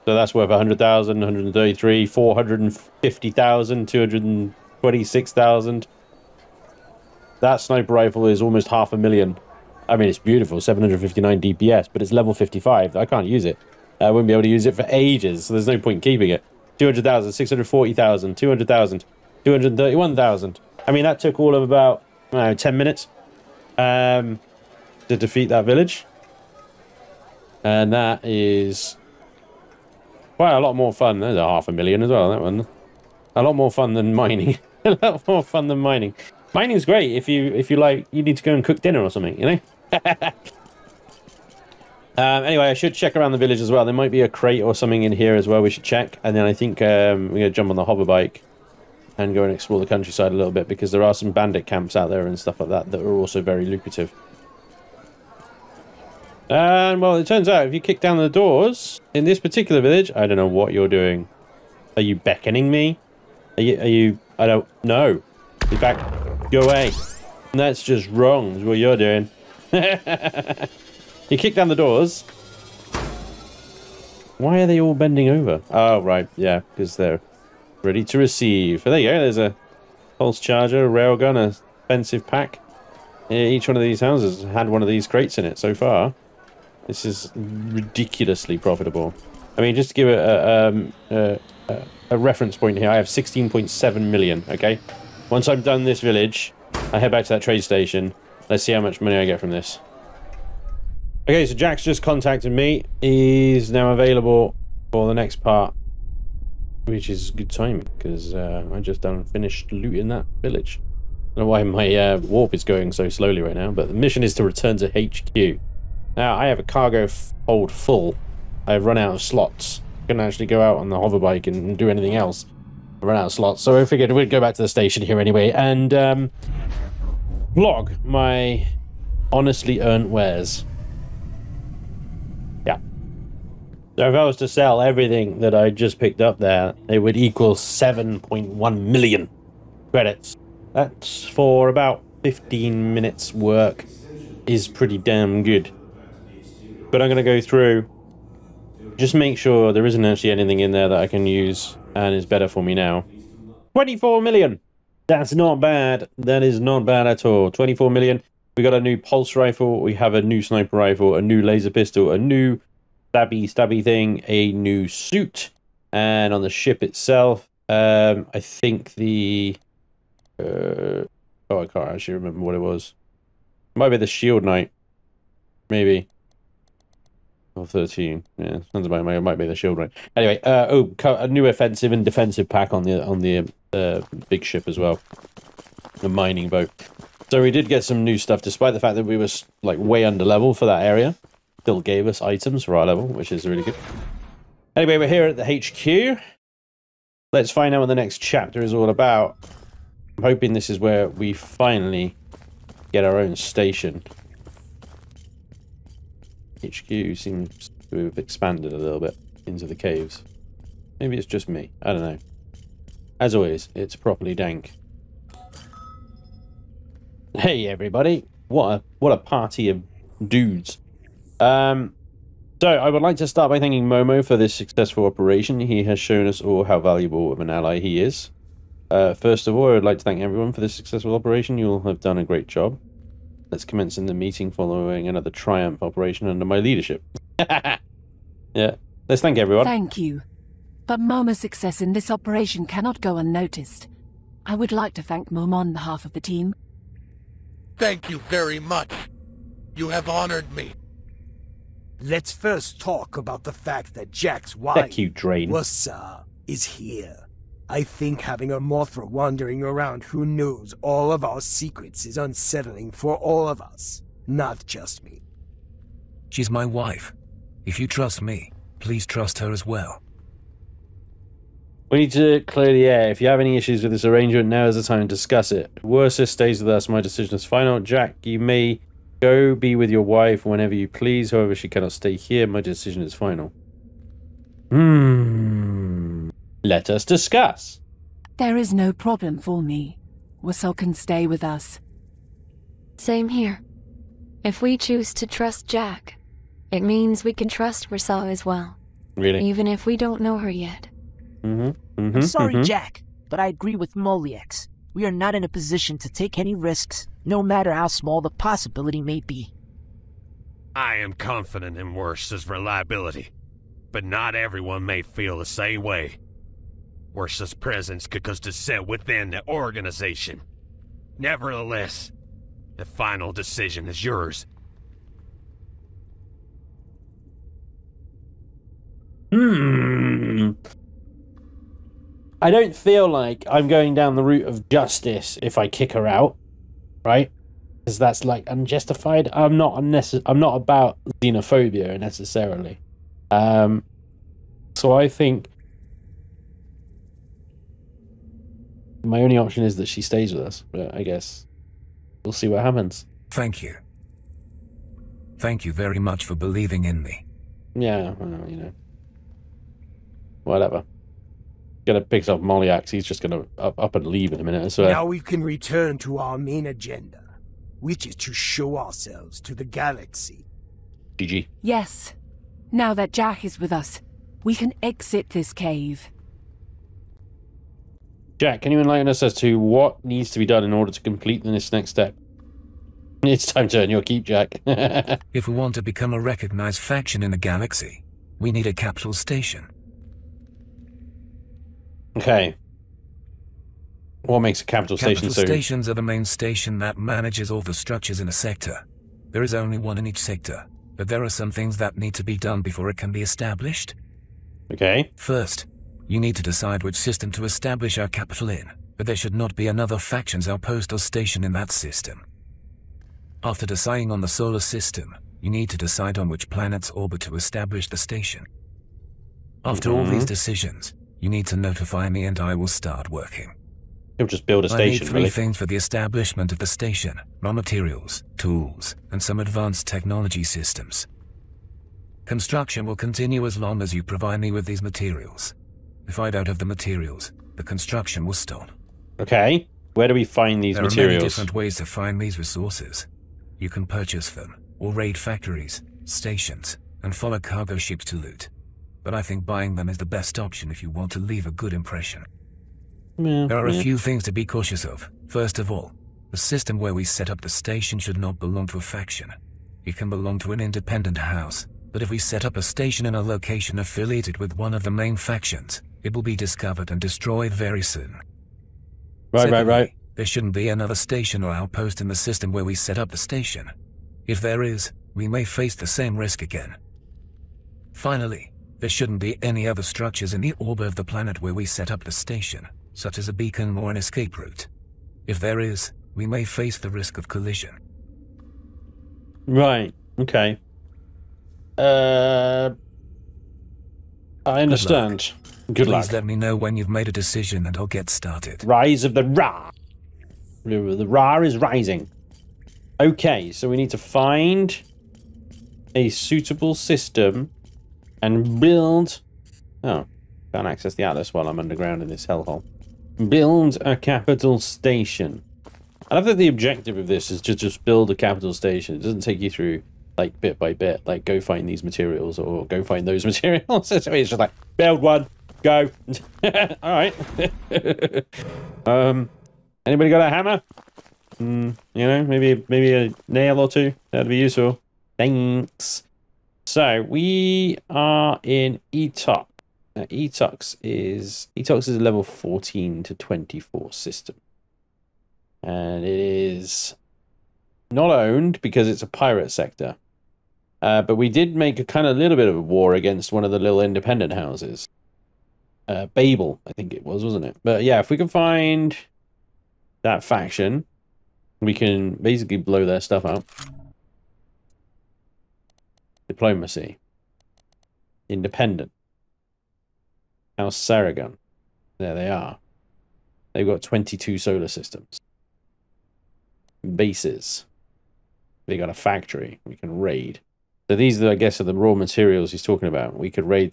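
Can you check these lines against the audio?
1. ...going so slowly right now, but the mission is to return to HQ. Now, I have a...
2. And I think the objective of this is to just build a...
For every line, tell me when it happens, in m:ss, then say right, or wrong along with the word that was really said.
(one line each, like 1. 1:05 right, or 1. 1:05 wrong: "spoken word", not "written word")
1. 1:52 right
2. 8:36 right.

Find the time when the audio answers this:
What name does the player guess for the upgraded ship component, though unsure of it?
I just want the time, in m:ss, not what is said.
2:54.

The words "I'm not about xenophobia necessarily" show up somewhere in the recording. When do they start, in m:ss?
5:40.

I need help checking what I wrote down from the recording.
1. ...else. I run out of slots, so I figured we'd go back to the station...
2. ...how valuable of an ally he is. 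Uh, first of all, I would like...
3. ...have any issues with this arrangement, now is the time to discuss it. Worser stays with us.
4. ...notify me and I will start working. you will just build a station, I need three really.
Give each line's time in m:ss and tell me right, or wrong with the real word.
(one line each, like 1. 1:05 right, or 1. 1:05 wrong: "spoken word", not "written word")
1. 2:02 right
2. 3:46 right
3. 4:33 right
4. 7:01 right.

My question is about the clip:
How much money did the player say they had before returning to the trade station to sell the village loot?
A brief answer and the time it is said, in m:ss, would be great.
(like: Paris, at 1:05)
16.7 million, at 1:33.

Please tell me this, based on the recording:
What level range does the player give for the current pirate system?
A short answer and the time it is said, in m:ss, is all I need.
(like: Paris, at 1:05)
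14 to 24, at 9:01.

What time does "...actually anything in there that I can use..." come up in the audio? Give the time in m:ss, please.
2:30.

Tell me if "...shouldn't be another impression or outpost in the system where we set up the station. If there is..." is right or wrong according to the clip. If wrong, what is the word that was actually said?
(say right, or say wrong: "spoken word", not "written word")
wrong: "station", not "impression".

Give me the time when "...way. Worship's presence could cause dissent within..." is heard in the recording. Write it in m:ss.
5:15.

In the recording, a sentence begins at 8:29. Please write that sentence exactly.
Oh, can't access the atlas while I'm underground in this hellhole.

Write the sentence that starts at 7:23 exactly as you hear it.
You can purchase them, or raid factories, stations, and follow cargo ships to loot.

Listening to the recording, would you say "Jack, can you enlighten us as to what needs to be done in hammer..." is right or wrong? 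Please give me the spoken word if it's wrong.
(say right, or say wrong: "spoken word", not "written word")
wrong: "order", not "hammer".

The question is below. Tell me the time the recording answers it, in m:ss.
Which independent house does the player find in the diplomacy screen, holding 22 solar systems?
9:30.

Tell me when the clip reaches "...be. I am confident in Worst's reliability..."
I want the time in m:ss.
5:09.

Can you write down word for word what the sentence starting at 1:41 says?
Okay, so Jack's just contacted me.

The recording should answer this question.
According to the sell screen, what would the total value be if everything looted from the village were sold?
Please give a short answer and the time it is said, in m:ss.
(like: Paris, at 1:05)
7.1 million credits, at 2:17.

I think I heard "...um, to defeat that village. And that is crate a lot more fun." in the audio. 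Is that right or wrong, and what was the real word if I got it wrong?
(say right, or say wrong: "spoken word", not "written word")
wrong: "quite", not "crate".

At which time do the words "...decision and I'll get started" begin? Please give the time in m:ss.
8:17.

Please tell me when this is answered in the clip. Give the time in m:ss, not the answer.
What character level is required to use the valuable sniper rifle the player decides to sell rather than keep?
0:12.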